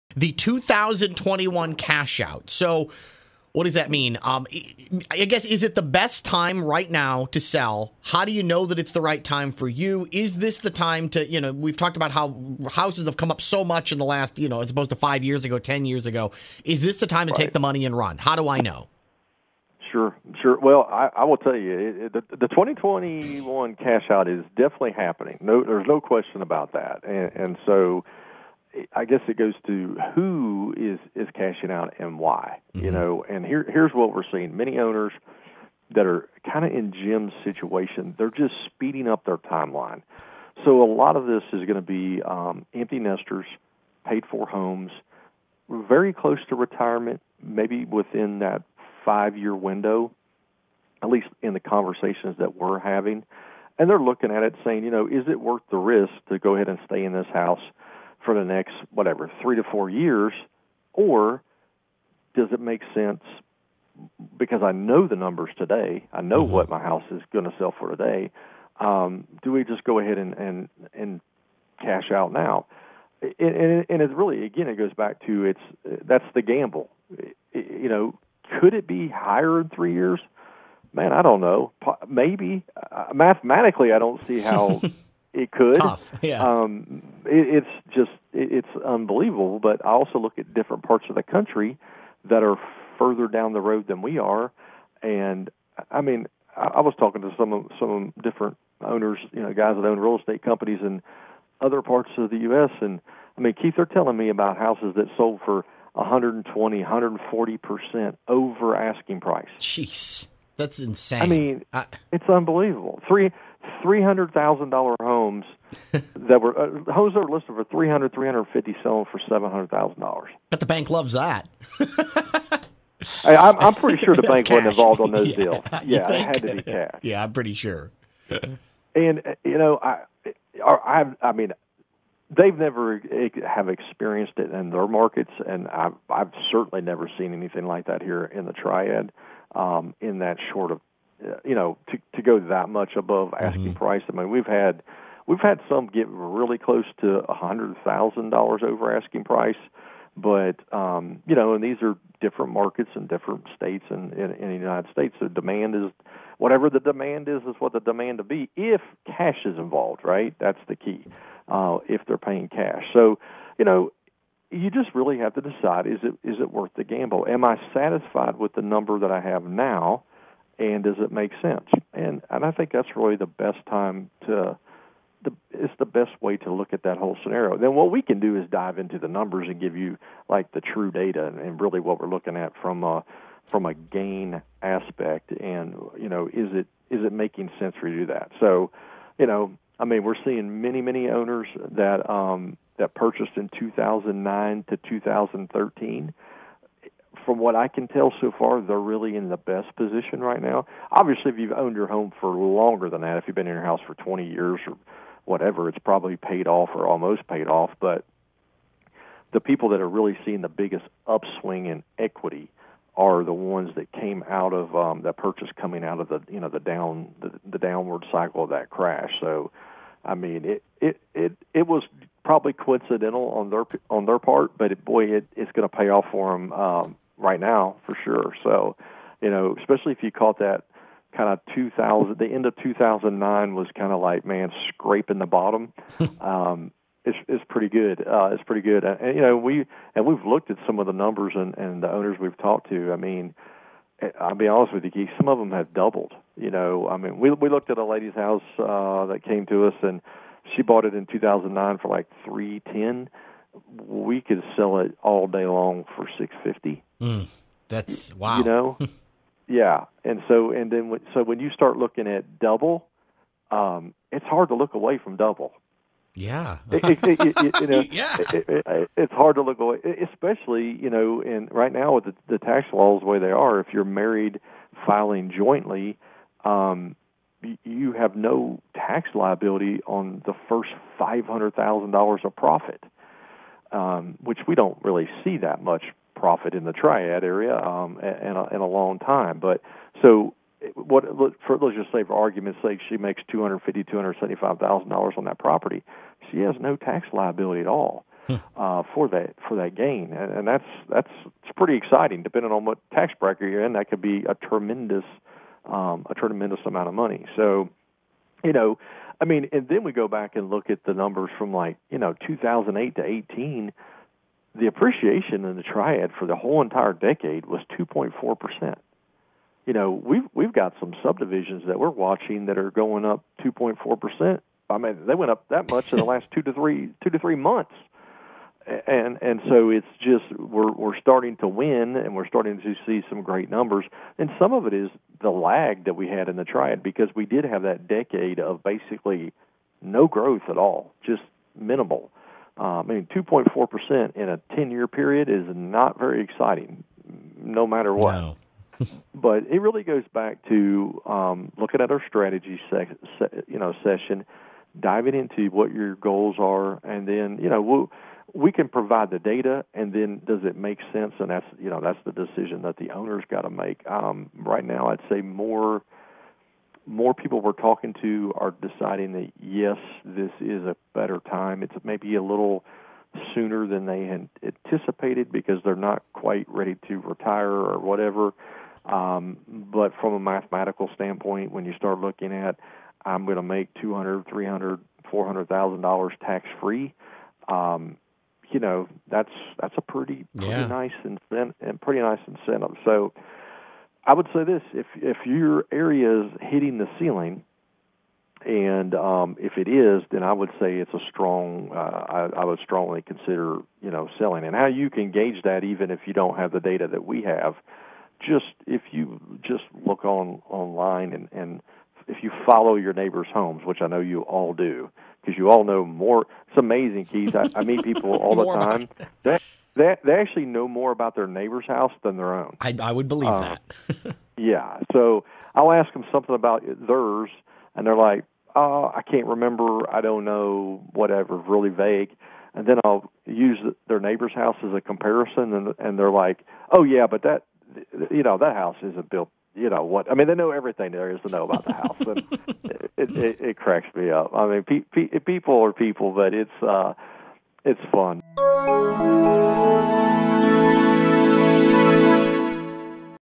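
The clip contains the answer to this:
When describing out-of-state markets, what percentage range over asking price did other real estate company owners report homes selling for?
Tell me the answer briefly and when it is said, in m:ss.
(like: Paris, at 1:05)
120 to 140 percent, at 1:45.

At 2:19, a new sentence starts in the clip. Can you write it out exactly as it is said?
Um, in that short of uh, you know, to to go that much above mm-hmm.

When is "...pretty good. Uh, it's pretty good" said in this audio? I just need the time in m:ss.
3:57.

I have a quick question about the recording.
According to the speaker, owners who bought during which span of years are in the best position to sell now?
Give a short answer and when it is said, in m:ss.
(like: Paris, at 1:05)
2009 to 2013, at 3:13.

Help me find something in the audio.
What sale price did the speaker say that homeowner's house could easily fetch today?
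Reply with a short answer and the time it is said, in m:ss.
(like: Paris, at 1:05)
650, at 4:16.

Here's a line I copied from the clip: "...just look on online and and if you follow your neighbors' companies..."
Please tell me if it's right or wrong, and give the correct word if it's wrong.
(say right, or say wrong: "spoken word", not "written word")
wrong: "homes", not "companies".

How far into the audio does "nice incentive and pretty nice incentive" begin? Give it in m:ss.
6:30.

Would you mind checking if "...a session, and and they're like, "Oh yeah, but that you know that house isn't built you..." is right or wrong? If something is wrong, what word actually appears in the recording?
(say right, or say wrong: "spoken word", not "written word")
wrong: "comparison", not "session".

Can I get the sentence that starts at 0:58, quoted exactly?
for the next, whatever, three to four years?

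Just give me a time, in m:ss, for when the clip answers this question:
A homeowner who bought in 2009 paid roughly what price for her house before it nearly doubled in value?
4:12.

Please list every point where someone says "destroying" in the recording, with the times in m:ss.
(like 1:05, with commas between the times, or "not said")
not said.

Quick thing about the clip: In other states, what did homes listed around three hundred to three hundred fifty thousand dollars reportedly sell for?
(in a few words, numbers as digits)
$700,000.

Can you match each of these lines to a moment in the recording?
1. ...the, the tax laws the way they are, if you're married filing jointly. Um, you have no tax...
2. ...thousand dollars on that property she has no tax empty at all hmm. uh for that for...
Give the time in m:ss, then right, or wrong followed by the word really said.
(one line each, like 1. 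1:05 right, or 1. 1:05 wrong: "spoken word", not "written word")
1. 4:32 right
2. 4:54 wrong: "liability", not "empty".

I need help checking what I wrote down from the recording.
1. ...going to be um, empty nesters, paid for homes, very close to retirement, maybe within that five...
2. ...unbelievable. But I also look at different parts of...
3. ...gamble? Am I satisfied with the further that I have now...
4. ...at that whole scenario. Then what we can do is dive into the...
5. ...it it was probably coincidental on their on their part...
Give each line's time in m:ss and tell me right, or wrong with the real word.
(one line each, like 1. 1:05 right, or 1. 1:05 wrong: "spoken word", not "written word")
1. 0:41 right
2. 1:28 right
3. 2:46 wrong: "number", not "further"
4. 2:56 right
5. 3:41 right.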